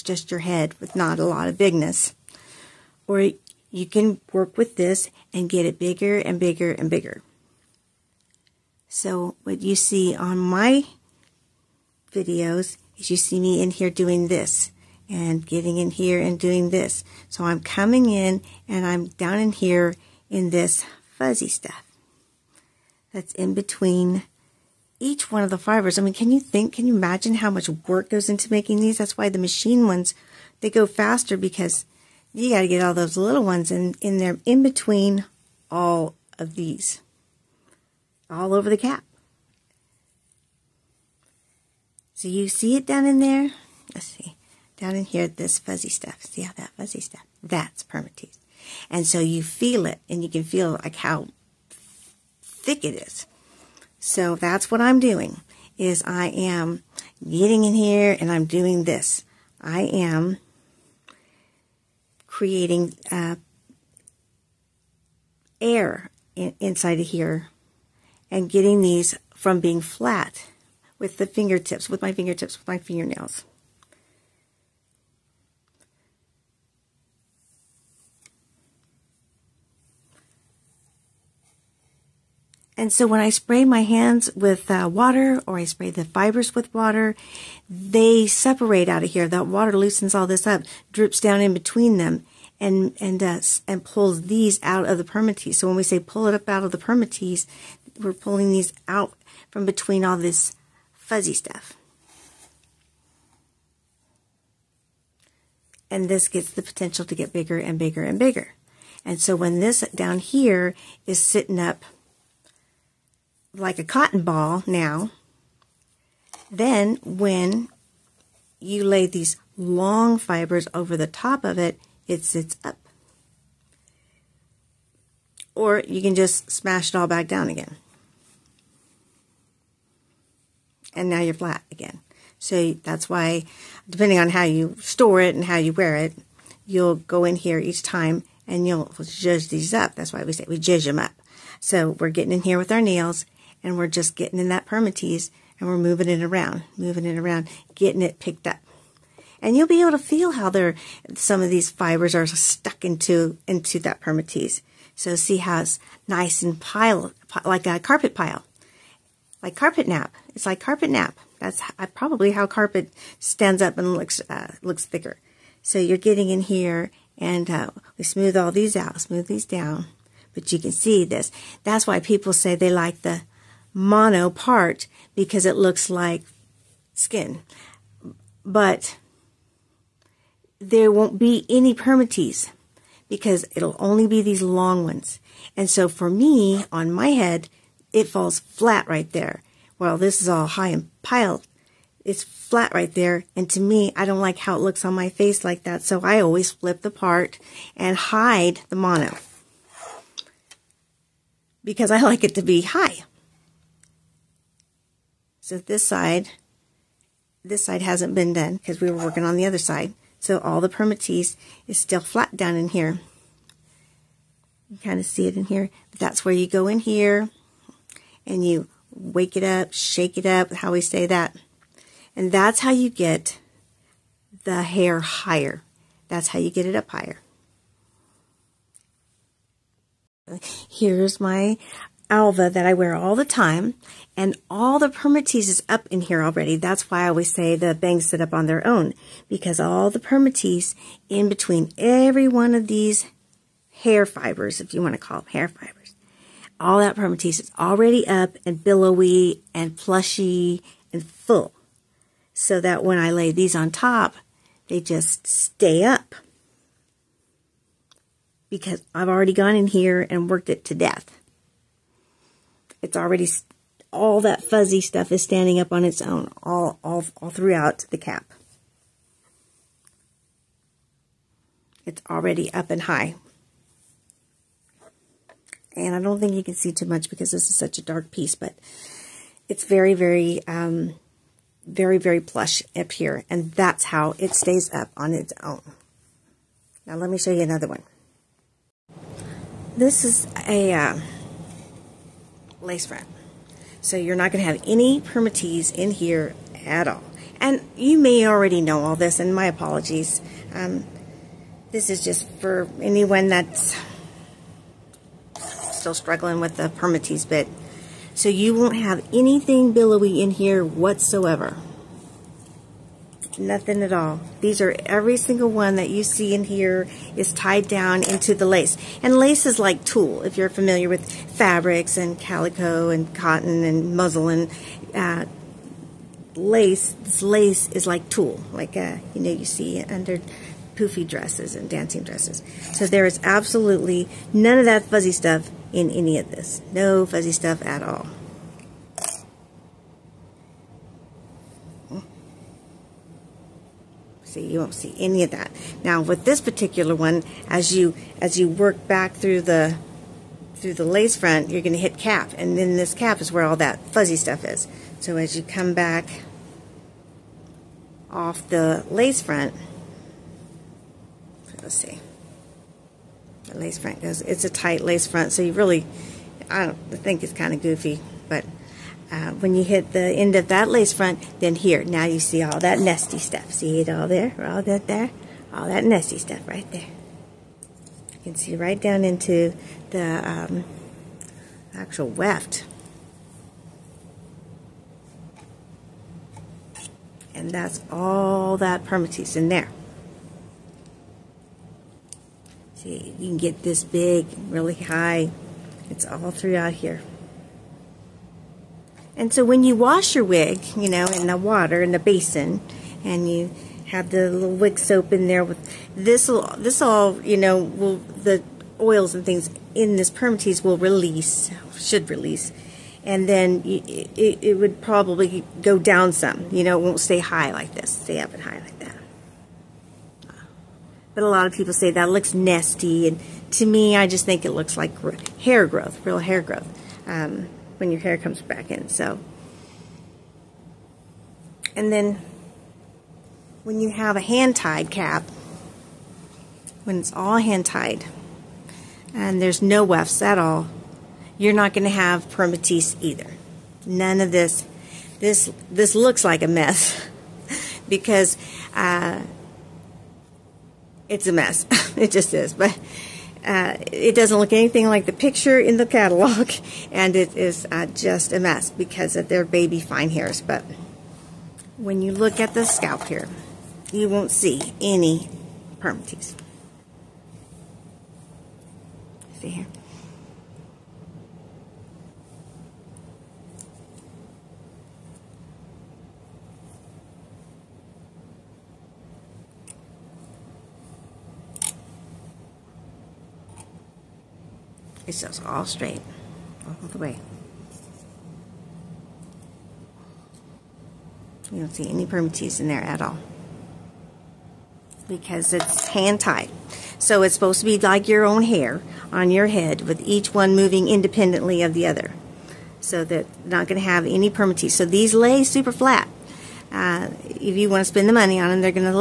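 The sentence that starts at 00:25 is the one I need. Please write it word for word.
I mean, can you think, can you imagine how much work goes into making these?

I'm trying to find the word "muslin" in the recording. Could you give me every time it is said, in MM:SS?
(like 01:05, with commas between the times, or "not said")
05:23.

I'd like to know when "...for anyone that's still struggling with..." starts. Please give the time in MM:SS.
05:02.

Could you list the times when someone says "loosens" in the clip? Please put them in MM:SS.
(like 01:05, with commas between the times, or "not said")
01:29.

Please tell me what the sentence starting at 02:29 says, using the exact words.
And you'll be able to feel how they some of these fibers are stuck into into that permatease.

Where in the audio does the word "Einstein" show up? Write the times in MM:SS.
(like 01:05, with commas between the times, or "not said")
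not said.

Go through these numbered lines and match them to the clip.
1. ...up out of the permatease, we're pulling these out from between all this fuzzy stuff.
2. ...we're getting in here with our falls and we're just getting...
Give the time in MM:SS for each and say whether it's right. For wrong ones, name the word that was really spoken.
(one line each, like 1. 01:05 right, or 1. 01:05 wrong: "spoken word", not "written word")
1. 01:36 right
2. 02:21 wrong: "nails", not "falls".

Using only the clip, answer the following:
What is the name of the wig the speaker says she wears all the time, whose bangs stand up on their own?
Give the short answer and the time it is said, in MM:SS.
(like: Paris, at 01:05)
Alva, at 03:52.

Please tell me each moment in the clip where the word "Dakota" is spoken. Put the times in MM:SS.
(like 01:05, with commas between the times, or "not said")
not said.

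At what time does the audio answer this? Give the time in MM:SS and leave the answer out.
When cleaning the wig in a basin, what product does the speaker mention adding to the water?
06:44.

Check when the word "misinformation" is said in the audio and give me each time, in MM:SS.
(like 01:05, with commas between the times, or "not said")
not said.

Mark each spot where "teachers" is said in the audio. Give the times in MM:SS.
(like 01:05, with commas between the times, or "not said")
not said.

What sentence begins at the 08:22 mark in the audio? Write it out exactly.
So they're not going to have any permatease.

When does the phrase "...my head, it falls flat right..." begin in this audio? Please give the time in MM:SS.
03:06.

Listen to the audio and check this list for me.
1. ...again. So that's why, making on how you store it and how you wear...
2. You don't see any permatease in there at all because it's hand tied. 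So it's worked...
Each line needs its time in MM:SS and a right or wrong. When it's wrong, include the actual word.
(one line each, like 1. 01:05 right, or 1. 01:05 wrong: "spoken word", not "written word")
1. 02:11 wrong: "depending", not "making"
2. 08:11 wrong: "supposed", not "worked".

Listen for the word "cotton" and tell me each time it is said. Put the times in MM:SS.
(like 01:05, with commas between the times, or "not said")
01:53, 05:23.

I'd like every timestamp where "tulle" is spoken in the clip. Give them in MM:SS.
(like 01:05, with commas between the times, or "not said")
05:19, 05:28.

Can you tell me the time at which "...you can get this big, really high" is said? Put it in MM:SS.
06:33.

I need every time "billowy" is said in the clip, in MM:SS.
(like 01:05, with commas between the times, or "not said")
04:08, 05:09.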